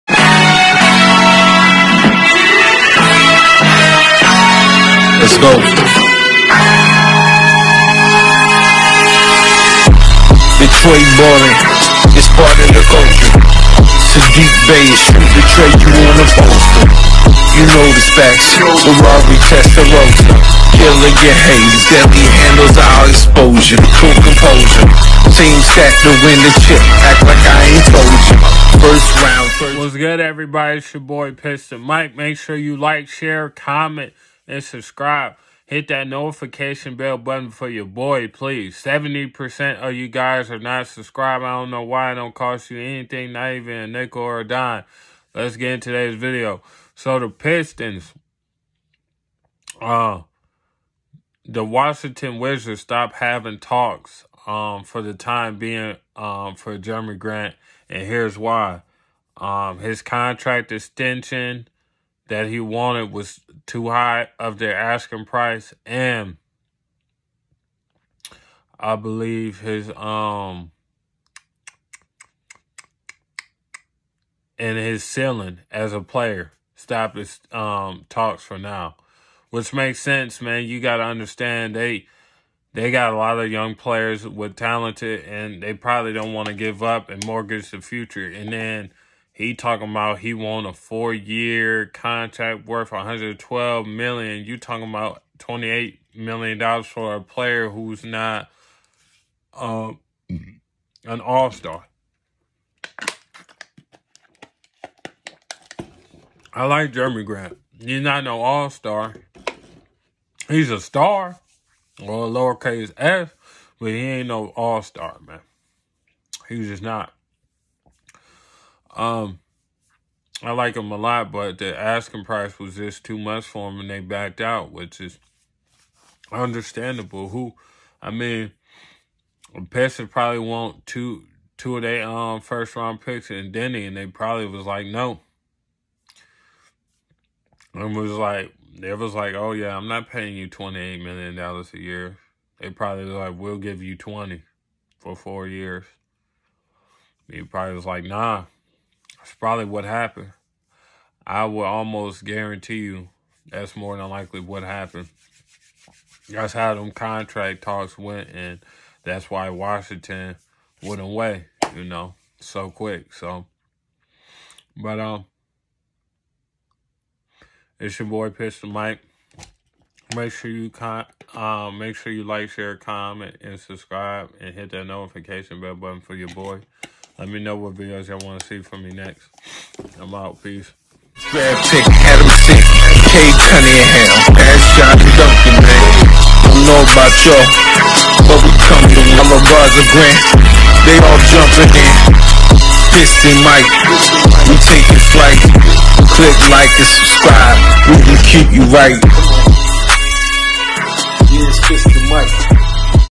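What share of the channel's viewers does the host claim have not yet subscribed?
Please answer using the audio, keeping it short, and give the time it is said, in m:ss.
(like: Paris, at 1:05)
70%, at 0:38.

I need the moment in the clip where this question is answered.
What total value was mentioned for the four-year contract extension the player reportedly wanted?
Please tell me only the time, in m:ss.
1:32.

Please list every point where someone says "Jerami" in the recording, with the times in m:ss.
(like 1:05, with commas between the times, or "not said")
0:56, 1:46.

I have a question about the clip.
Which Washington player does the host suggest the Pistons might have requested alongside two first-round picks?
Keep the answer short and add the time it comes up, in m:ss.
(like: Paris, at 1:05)
Deni, at 2:13.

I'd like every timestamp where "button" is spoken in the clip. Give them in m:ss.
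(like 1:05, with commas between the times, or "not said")
0:37, 2:55.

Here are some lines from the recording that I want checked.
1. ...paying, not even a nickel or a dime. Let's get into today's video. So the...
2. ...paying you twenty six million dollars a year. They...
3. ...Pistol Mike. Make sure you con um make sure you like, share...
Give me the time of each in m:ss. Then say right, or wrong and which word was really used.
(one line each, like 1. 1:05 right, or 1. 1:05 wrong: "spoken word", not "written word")
1. 0:42 wrong: "anything", not "paying"
2. 2:20 wrong: "eight", not "six"
3. 2:48 right.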